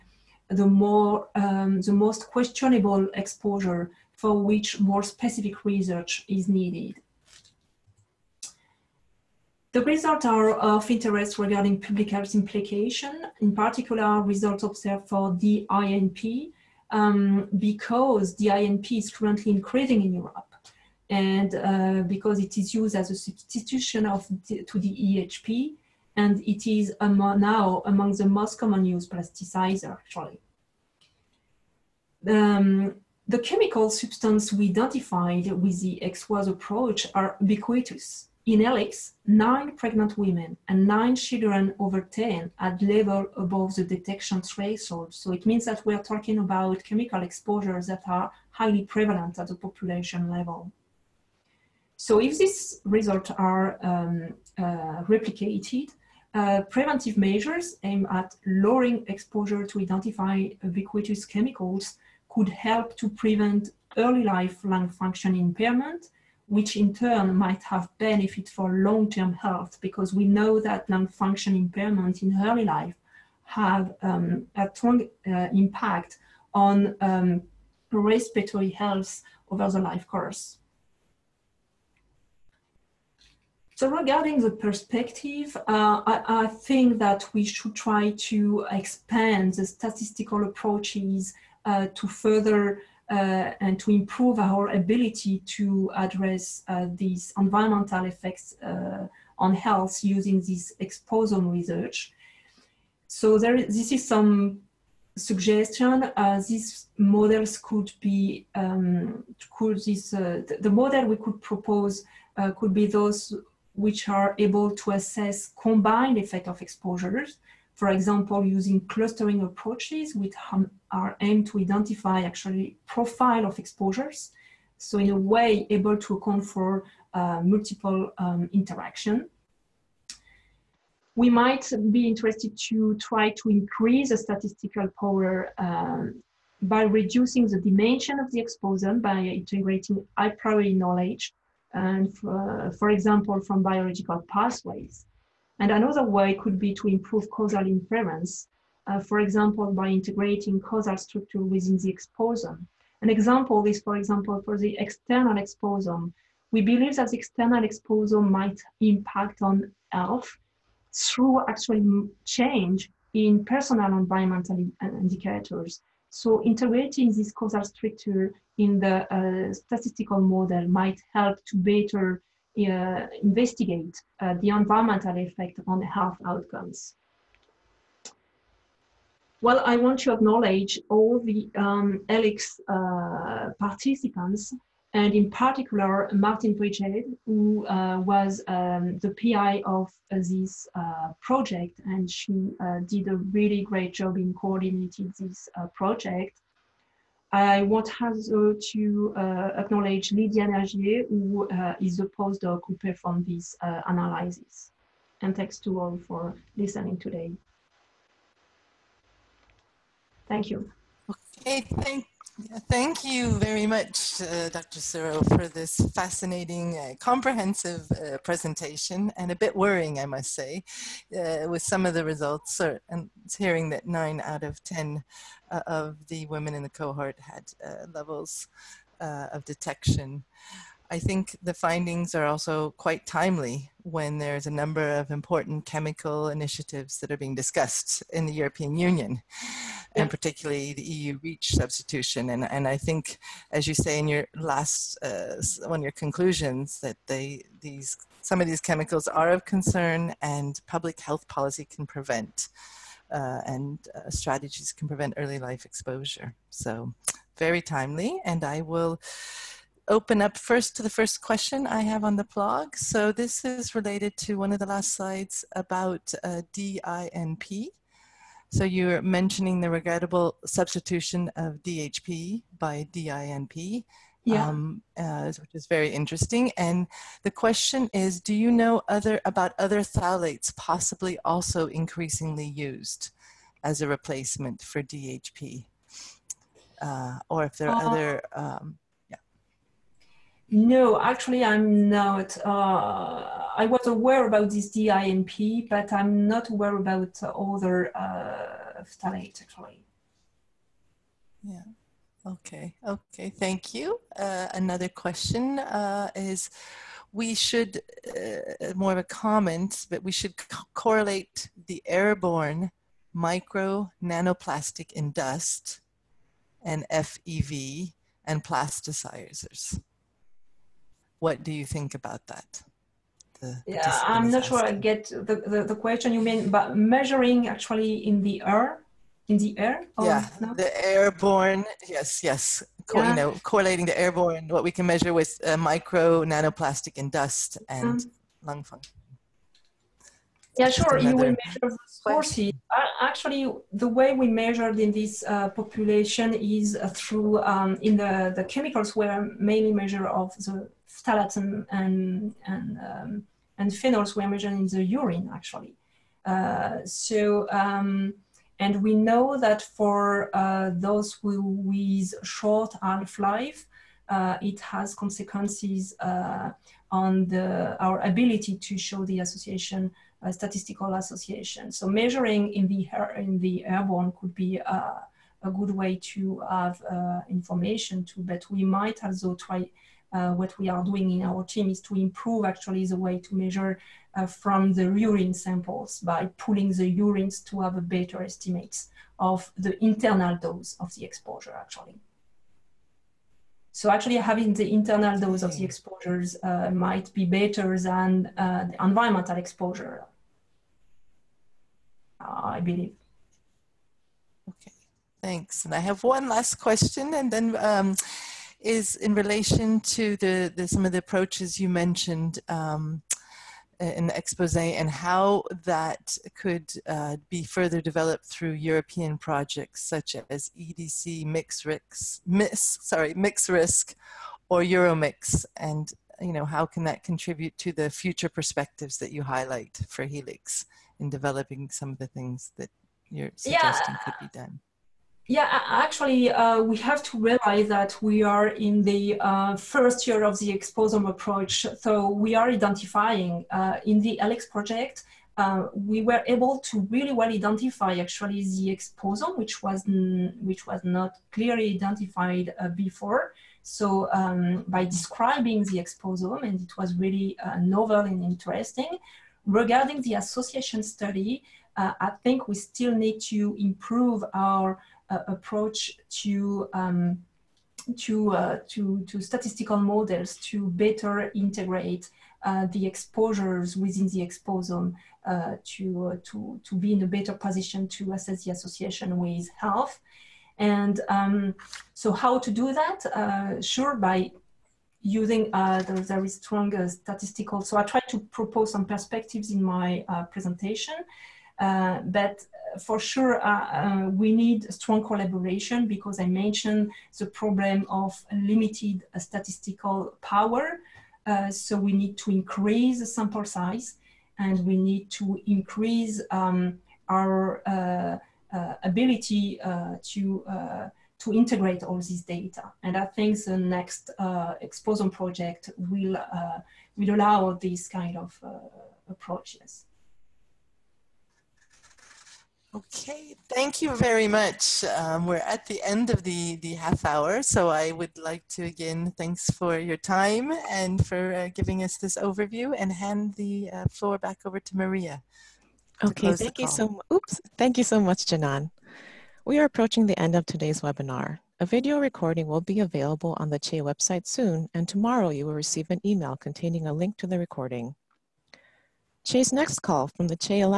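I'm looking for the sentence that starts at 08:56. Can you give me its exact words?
To okay, thank you so oops, thank you so much, Génon.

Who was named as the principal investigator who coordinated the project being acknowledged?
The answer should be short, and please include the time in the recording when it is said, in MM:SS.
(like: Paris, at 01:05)
Martine Vrijheid, at 03:06.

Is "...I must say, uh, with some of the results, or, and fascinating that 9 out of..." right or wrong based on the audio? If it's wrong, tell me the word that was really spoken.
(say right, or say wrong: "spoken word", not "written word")
wrong: "hearing", not "fascinating".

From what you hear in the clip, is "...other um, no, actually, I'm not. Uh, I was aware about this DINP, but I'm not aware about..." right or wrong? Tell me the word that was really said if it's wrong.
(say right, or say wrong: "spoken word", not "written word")
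right.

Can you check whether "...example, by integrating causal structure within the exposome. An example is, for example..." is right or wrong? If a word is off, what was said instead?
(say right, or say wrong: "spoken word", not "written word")
right.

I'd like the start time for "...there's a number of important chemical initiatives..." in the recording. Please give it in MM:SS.
03:54.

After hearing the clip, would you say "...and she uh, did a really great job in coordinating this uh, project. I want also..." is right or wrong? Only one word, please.
right.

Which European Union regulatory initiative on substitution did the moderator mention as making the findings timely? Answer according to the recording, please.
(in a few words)
EU REACH.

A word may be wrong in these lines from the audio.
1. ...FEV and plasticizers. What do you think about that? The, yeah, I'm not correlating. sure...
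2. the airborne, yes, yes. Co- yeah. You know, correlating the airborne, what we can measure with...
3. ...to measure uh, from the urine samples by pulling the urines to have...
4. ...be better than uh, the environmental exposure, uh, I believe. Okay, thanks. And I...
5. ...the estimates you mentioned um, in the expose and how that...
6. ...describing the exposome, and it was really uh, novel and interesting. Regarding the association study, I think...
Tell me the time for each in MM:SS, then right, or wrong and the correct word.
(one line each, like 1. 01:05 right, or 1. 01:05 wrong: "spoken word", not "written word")
1. 05:16 wrong: "asking", not "correlating"
2. 05:30 right
3. 06:23 right
4. 06:37 right
5. 06:50 wrong: "approaches", not "estimates"
6. 07:34 right.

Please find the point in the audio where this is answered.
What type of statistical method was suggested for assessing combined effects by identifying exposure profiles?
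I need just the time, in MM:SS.
01:58.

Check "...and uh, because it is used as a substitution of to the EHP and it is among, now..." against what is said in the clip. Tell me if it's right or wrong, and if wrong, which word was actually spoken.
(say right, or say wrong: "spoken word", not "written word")
right.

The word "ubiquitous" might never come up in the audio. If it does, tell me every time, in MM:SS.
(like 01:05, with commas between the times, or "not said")
00:37, 01:00.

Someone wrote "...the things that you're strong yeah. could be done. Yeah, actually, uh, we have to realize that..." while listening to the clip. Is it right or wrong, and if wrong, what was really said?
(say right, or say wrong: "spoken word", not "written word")
wrong: "suggesting", not "strong".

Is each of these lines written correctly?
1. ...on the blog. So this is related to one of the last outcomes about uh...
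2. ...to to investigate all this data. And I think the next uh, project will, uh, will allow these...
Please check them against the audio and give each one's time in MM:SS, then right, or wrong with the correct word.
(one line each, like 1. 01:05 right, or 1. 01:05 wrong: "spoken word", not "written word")
1. 04:22 wrong: "slides", not "outcomes"
2. 08:30 wrong: "integrate", not "investigate".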